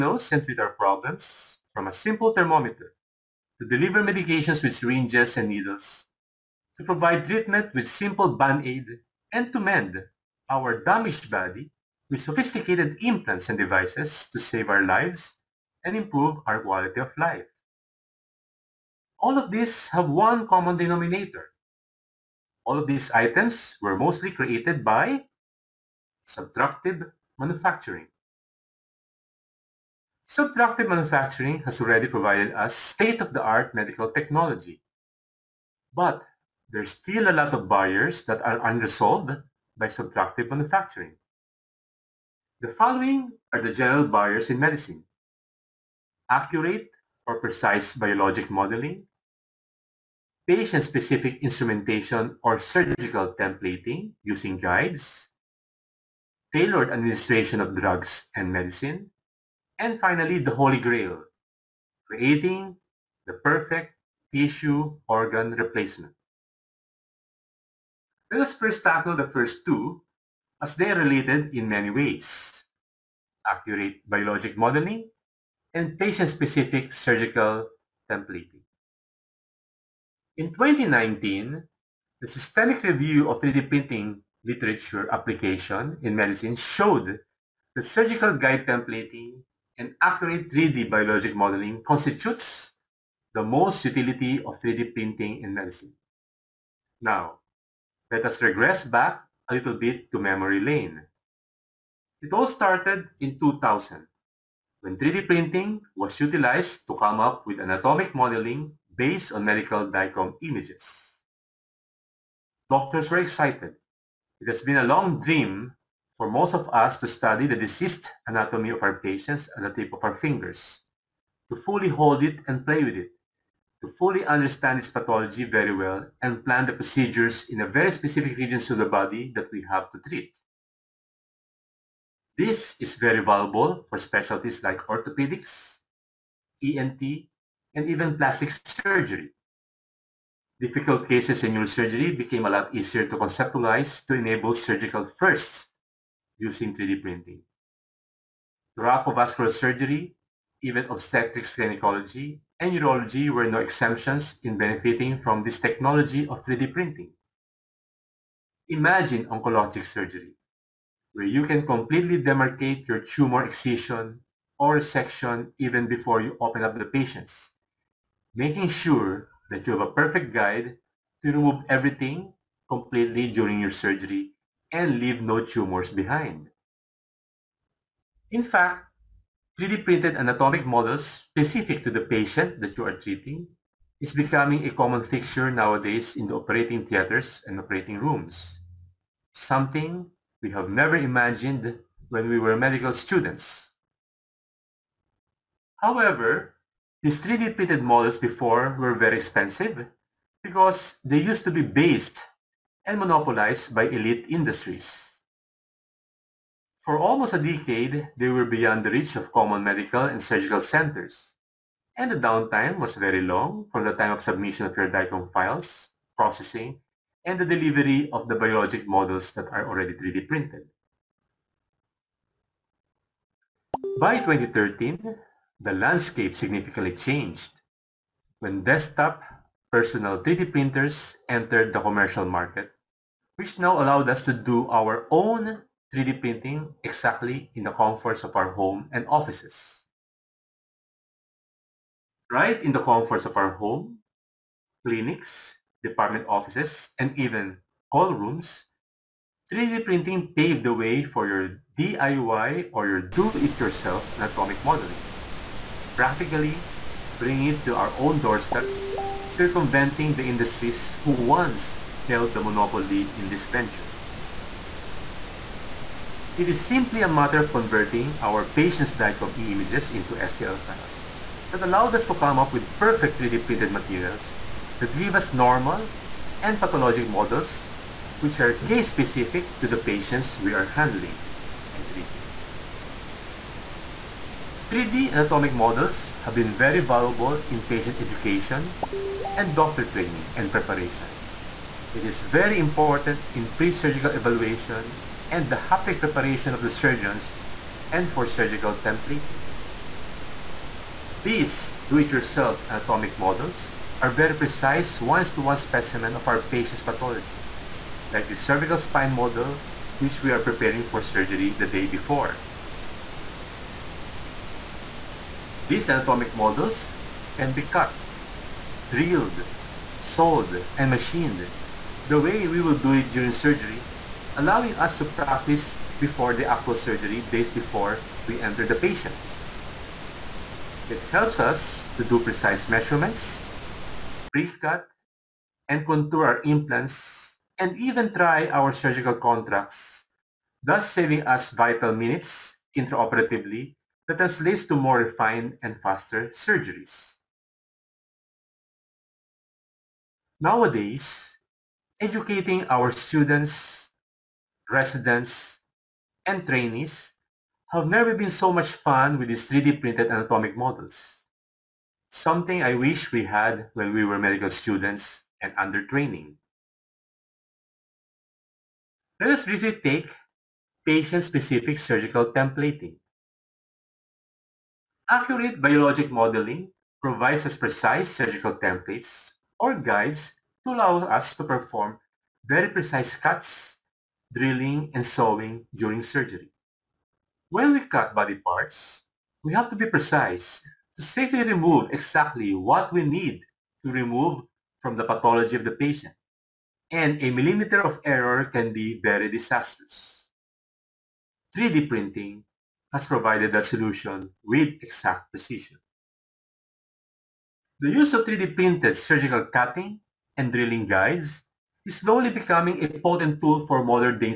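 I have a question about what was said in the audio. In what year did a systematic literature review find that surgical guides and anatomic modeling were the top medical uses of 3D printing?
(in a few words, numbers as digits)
2019.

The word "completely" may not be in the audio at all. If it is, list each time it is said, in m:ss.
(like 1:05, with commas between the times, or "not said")
2:41, 2:52.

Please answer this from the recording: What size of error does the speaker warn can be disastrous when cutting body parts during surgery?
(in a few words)
a millimeter.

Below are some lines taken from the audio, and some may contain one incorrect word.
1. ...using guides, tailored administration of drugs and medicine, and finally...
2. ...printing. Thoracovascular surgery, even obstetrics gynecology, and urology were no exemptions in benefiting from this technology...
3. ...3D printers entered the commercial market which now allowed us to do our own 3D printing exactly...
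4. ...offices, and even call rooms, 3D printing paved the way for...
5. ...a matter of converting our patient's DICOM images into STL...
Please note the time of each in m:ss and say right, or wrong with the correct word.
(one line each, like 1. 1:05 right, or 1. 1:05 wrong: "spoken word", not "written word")
1. 0:54 right
2. 2:27 right
3. 3:50 right
4. 4:06 right
5. 4:27 right.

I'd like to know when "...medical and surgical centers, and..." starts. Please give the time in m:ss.
3:29.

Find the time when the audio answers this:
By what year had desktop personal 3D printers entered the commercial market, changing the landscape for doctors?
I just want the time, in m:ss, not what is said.
3:44.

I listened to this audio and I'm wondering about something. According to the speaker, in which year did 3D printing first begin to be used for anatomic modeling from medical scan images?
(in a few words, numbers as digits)
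2000.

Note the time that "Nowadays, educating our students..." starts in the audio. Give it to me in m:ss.
5:50.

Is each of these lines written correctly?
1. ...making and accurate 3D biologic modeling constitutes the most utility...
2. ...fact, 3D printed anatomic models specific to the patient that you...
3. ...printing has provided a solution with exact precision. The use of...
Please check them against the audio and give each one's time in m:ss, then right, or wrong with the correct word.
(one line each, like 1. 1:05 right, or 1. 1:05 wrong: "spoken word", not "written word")
1. 1:28 wrong: "templating", not "making"
2. 2:58 right
3. 6:41 right.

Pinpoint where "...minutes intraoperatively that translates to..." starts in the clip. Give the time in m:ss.
5:41.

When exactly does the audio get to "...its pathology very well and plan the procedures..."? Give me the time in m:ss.
2:04.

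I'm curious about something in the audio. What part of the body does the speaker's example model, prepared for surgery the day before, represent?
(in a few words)
cervical spine.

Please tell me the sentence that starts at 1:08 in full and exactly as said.
Let us first tackle the first two as they are related in many ways.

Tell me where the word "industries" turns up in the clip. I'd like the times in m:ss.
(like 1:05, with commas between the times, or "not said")
3:24, 4:20.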